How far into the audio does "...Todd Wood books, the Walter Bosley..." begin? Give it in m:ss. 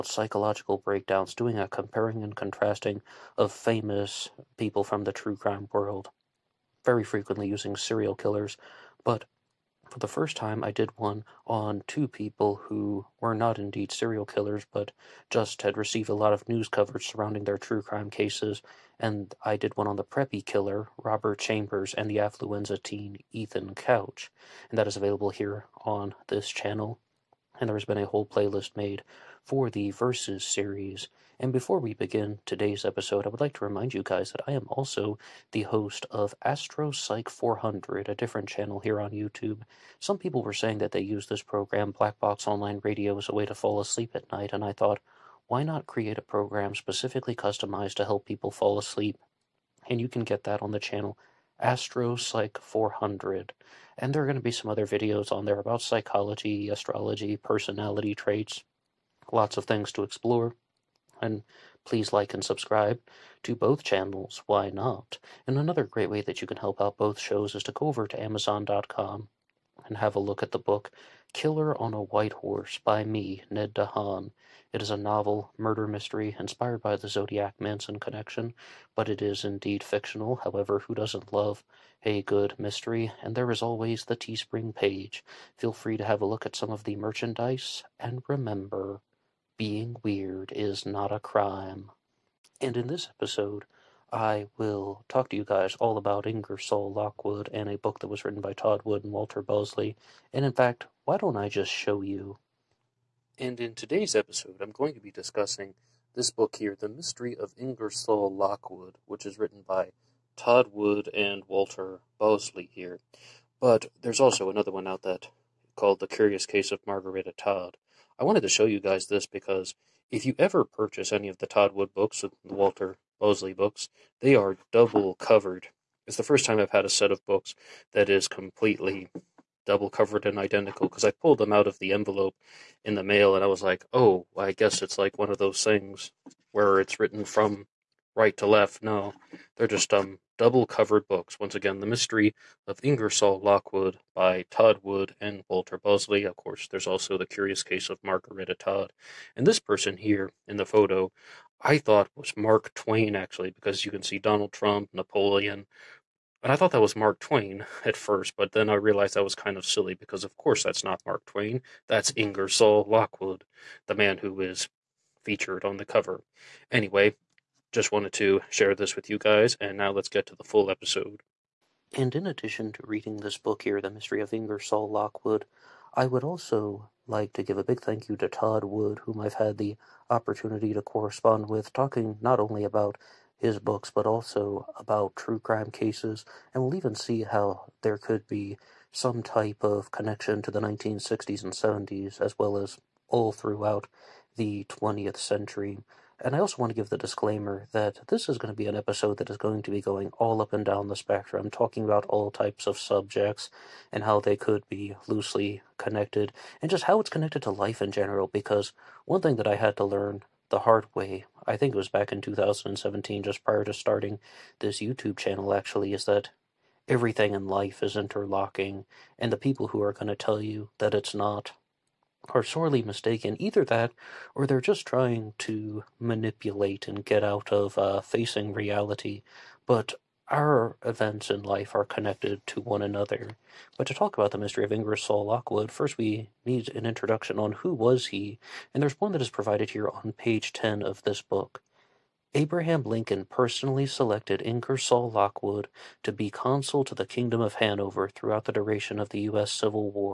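2:01.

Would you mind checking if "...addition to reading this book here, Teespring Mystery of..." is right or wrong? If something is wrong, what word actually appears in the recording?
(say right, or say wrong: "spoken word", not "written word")
wrong: "The", not "Teespring".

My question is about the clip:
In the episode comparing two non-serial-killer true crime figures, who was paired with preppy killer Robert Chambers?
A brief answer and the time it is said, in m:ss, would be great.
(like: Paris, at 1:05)
Ethan Couch, at 0:23.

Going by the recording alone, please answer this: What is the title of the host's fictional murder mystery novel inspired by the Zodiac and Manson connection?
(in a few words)
Killer on a White Horse.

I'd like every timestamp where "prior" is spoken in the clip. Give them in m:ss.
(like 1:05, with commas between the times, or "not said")
3:33.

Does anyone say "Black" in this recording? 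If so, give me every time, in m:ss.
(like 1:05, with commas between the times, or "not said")
0:41.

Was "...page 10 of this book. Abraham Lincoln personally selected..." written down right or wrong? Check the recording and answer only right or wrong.
right.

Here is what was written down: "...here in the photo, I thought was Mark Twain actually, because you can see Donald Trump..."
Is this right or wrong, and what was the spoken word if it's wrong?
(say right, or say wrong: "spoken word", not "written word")
right.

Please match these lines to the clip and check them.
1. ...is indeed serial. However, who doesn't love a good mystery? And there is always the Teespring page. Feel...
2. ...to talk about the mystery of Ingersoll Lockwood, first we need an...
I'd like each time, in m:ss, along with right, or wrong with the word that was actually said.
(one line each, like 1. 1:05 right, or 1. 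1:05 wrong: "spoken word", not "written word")
1. 1:19 wrong: "fictional", not "serial"
2. 3:53 right.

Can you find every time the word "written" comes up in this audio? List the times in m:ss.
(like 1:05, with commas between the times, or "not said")
1:38, 1:49, 2:16.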